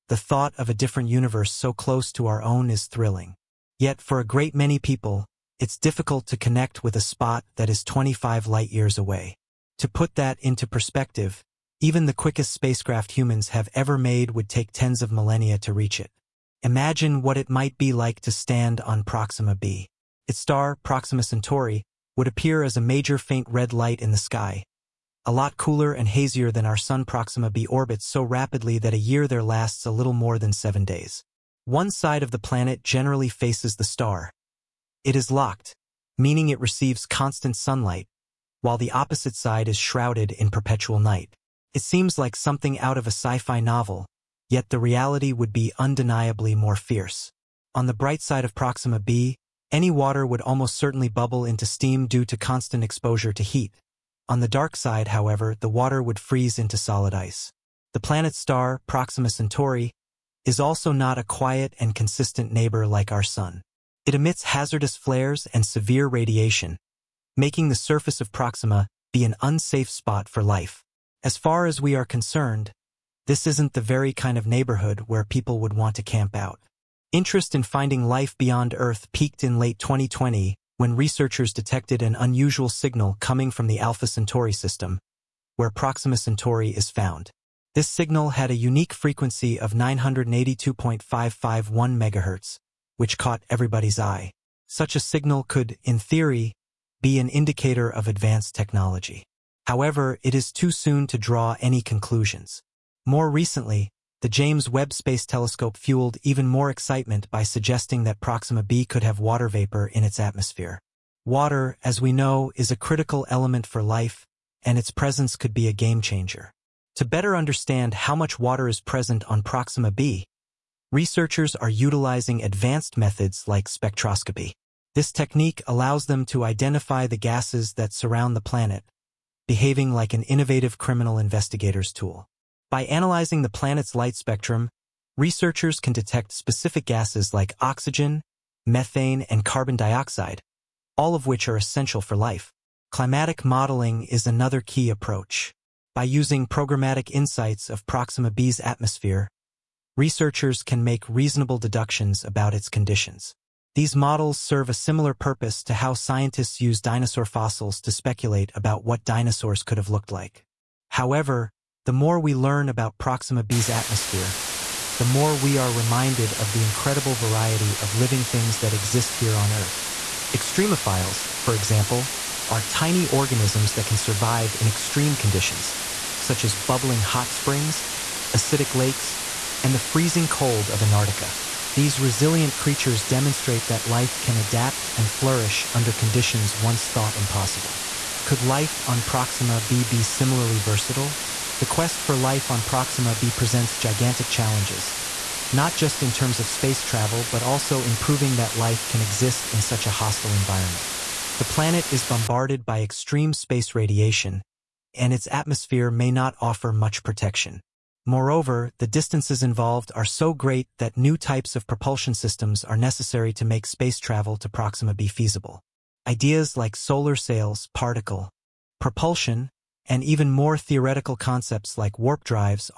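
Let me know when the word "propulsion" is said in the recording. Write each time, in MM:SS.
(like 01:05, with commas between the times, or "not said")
03:31, 03:38.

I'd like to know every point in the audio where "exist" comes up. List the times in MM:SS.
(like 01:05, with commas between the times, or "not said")
02:48, 03:19.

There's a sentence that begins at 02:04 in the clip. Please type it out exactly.
This technique allows them to identify the gases that surround the planet, behaving like an innovative criminal investigator's tool.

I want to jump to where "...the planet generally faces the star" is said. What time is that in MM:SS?
00:32.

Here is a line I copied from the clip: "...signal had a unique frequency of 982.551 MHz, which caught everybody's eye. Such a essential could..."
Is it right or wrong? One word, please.
wrong.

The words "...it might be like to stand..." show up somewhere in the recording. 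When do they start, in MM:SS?
00:17.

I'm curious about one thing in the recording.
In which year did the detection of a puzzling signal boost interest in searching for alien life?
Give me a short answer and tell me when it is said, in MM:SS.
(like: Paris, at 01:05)
2020, at 01:19.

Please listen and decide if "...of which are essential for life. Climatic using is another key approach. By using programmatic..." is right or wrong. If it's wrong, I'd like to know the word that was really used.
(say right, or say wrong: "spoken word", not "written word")
wrong: "modeling", not "using".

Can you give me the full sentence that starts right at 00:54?
On the dark side, however, the water would freeze into solid ice.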